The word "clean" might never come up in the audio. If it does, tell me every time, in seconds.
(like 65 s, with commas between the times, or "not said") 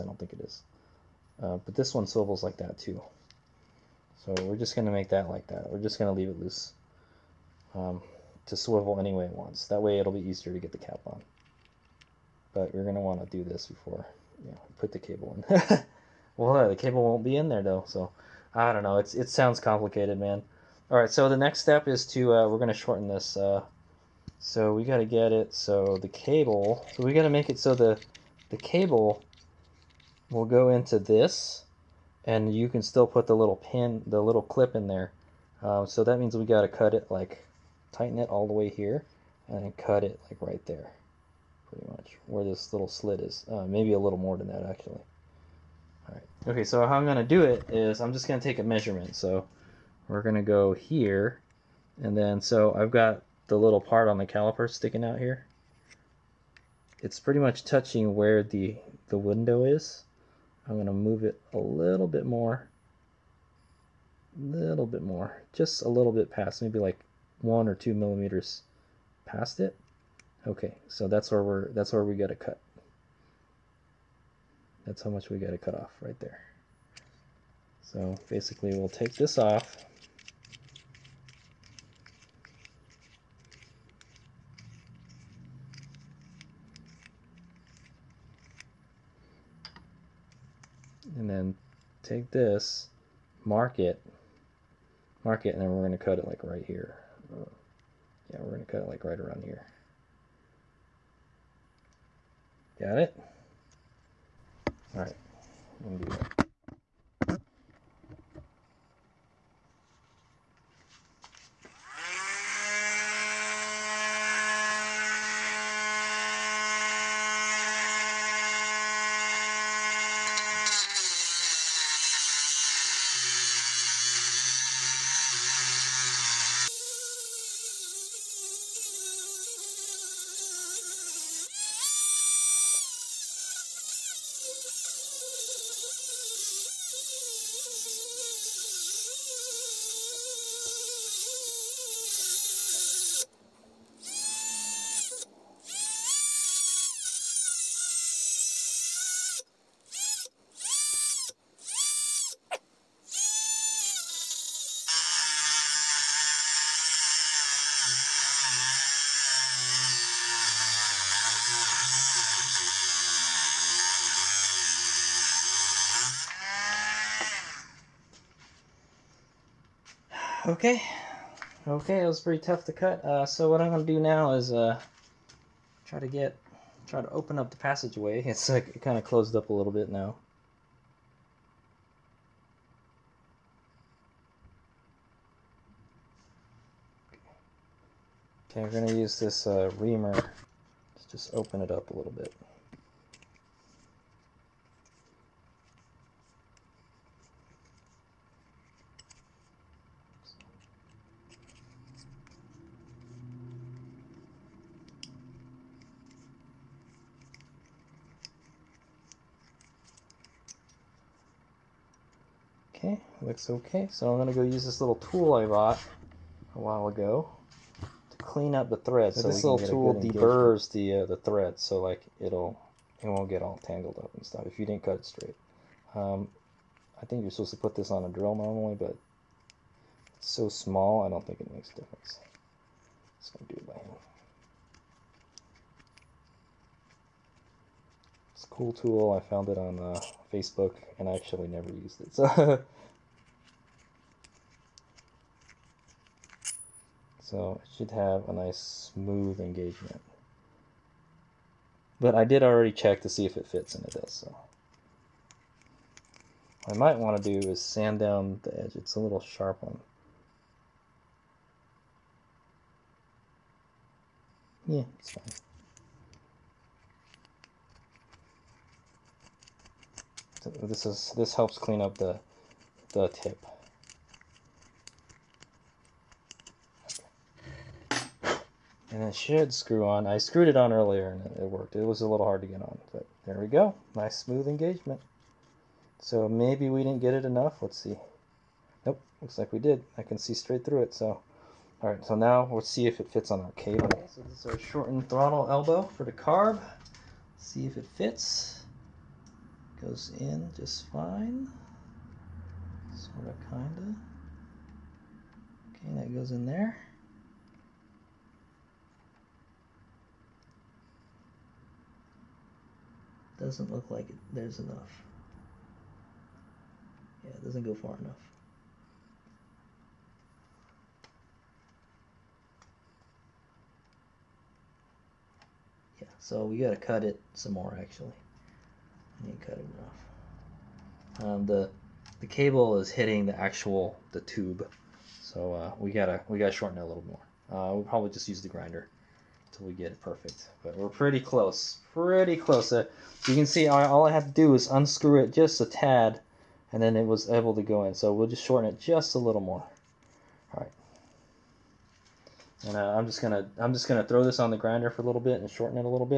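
218 s, 271 s.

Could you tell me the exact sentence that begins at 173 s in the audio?
Uh, so what I'm going to do now is uh, try to get, try to open up the passageway.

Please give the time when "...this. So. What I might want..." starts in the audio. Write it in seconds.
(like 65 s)
253 s.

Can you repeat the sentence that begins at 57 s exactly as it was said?
It's pretty much touching where the, the window is.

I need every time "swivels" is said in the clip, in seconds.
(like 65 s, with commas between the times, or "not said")
2 s, 8 s.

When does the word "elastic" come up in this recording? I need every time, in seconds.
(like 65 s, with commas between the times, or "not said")
not said.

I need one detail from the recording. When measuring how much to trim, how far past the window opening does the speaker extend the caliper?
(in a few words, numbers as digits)
1 or 2 millimeters.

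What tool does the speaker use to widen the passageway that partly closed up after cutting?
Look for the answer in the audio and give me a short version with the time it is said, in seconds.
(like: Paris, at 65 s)
reamer, at 189 s.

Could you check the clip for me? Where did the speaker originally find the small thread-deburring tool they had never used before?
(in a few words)
Facebook.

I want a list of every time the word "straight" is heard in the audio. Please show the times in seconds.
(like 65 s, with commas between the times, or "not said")
225 s, 290 s.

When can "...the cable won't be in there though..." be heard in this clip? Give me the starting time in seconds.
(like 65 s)
16 s.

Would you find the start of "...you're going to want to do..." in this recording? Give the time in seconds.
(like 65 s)
12 s.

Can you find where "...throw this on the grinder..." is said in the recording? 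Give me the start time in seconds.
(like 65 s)
354 s.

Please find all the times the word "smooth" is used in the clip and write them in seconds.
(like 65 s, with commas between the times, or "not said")
248 s, 284 s.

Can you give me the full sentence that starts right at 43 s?
Uh, maybe a little more than that actually.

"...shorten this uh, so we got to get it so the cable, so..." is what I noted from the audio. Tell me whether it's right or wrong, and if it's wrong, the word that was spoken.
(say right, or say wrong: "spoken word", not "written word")
right.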